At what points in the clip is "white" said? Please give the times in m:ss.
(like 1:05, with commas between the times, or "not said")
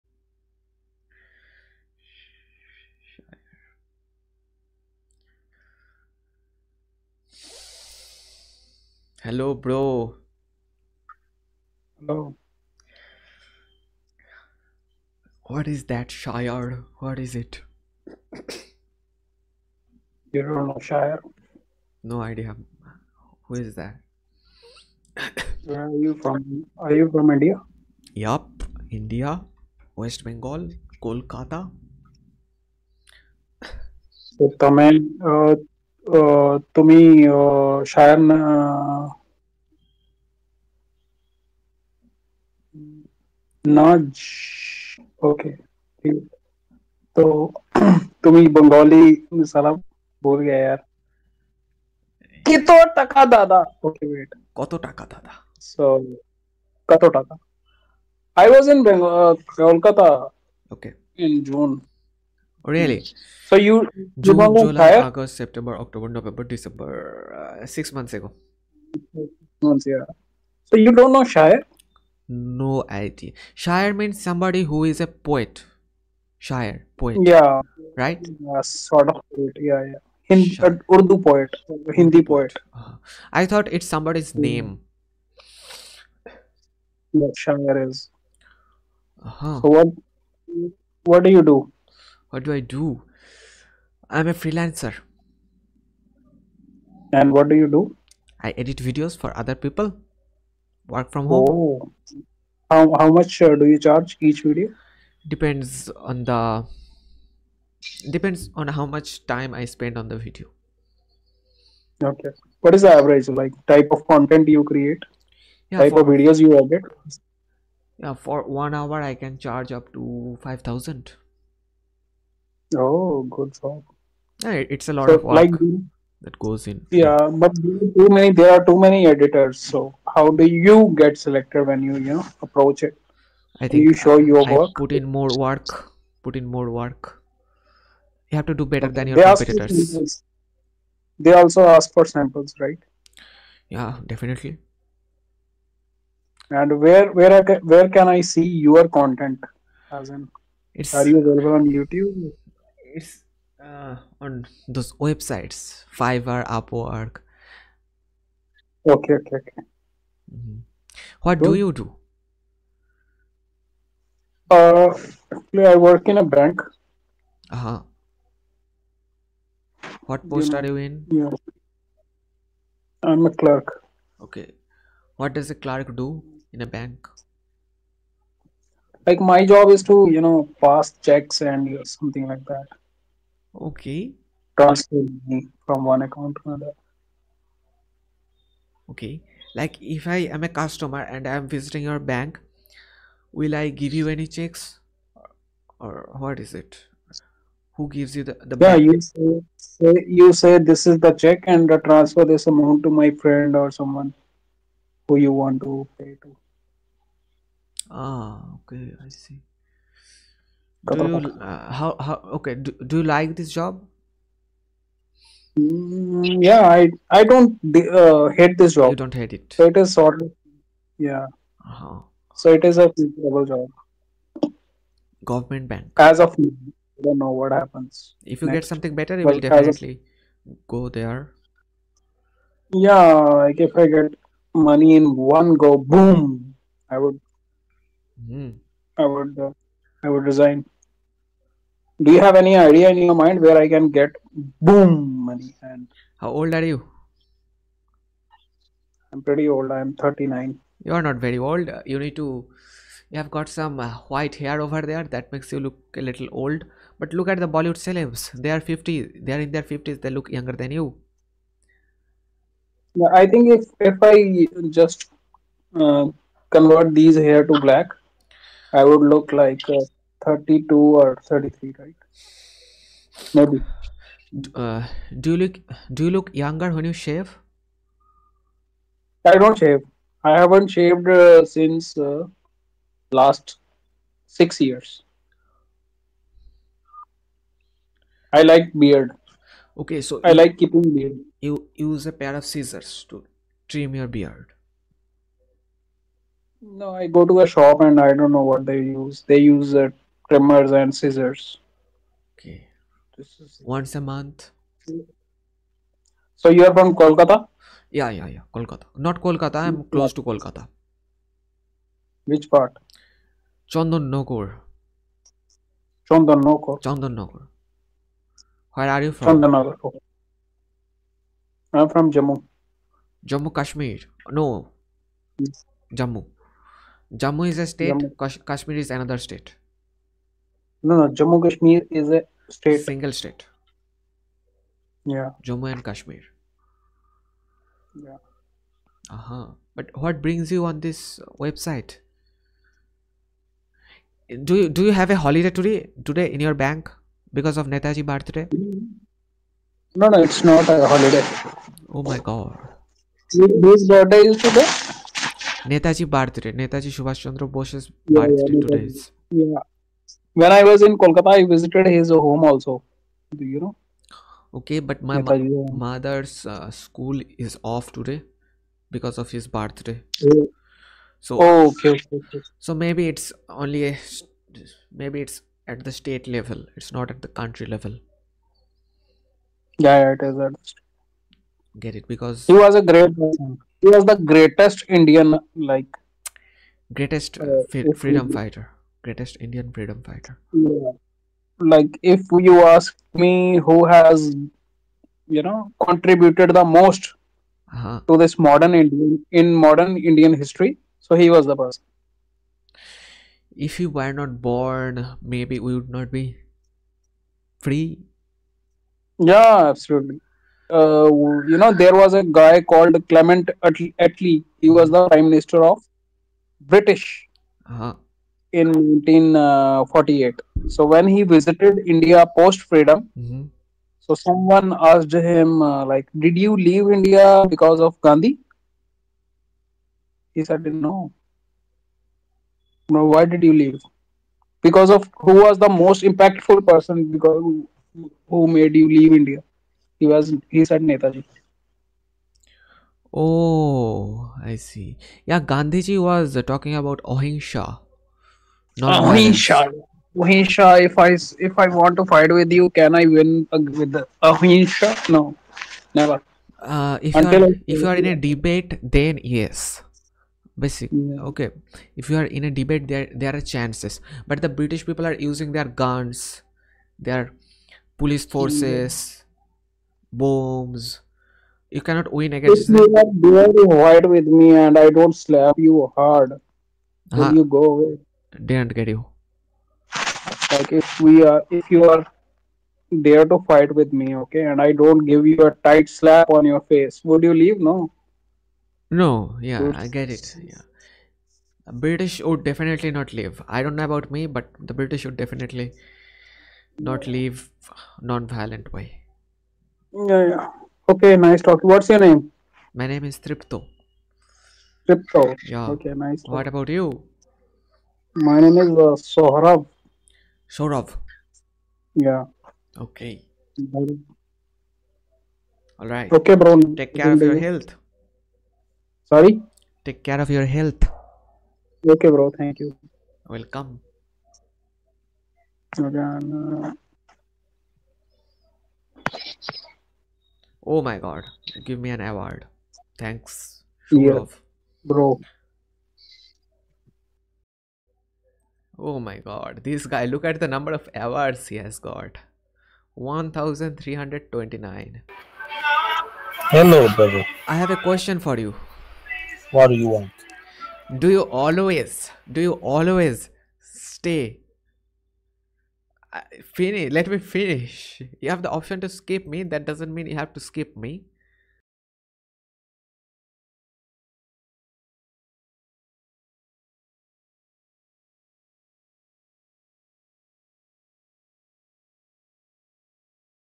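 4:14, 7:53.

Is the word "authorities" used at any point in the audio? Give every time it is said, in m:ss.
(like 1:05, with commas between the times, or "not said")
not said.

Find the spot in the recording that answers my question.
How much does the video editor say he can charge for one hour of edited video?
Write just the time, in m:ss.
2:00.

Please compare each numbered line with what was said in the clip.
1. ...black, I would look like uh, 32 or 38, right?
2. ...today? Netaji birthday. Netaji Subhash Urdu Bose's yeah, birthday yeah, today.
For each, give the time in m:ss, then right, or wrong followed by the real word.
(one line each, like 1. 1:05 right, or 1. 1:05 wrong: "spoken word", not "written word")
1. 4:27 wrong: "33", not "38"
2. 5:54 wrong: "Chandra", not "Urdu".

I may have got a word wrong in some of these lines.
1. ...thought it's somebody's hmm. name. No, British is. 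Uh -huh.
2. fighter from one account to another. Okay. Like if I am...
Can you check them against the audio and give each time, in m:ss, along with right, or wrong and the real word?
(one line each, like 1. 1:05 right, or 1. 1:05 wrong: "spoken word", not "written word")
1. 1:23 wrong: "Shire", not "British"
2. 3:04 wrong: "transfer", not "fighter".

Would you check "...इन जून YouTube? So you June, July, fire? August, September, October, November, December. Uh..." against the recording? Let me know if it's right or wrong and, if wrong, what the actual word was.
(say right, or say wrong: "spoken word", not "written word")
wrong: "Really", not "YouTube".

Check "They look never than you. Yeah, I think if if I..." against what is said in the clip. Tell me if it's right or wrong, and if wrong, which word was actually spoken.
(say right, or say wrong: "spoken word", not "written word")
wrong: "younger", not "never".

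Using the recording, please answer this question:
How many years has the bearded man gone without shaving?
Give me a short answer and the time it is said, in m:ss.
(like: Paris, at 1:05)
6, at 4:44.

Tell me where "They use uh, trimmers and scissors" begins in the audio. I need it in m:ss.
4:59.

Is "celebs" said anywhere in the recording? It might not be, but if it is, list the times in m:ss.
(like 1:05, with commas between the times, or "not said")
4:17.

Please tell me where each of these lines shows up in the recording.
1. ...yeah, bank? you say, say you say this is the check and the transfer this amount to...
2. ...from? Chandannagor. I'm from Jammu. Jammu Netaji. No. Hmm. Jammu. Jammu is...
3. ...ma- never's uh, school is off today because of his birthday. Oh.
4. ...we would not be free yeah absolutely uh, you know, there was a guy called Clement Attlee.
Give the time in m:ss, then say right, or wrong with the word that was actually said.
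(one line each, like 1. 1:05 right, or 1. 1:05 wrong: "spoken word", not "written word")
1. 3:18 right
2. 5:19 wrong: "Kashmir", not "Netaji"
3. 6:05 wrong: "mother", not "never"
4. 6:45 right.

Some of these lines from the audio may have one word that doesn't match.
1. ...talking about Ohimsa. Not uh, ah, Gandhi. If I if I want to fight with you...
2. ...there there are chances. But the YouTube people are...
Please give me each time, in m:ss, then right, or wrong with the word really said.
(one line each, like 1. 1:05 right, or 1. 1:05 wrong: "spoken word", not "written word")
1. 7:26 wrong: "Ohimsa", not "Gandhi"
2. 7:42 wrong: "British", not "YouTube".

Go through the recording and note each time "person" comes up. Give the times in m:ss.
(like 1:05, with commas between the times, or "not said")
6:23, 6:41, 7:16.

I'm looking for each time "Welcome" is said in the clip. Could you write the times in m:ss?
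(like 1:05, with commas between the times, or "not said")
8:43.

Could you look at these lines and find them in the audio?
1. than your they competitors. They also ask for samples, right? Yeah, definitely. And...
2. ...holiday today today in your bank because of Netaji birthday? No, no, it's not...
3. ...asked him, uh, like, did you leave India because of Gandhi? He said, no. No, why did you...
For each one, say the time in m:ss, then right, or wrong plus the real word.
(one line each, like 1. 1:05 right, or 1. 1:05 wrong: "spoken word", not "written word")
1. 2:18 right
2. 5:45 right
3. 7:04 right.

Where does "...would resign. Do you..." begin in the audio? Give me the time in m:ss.
4:00.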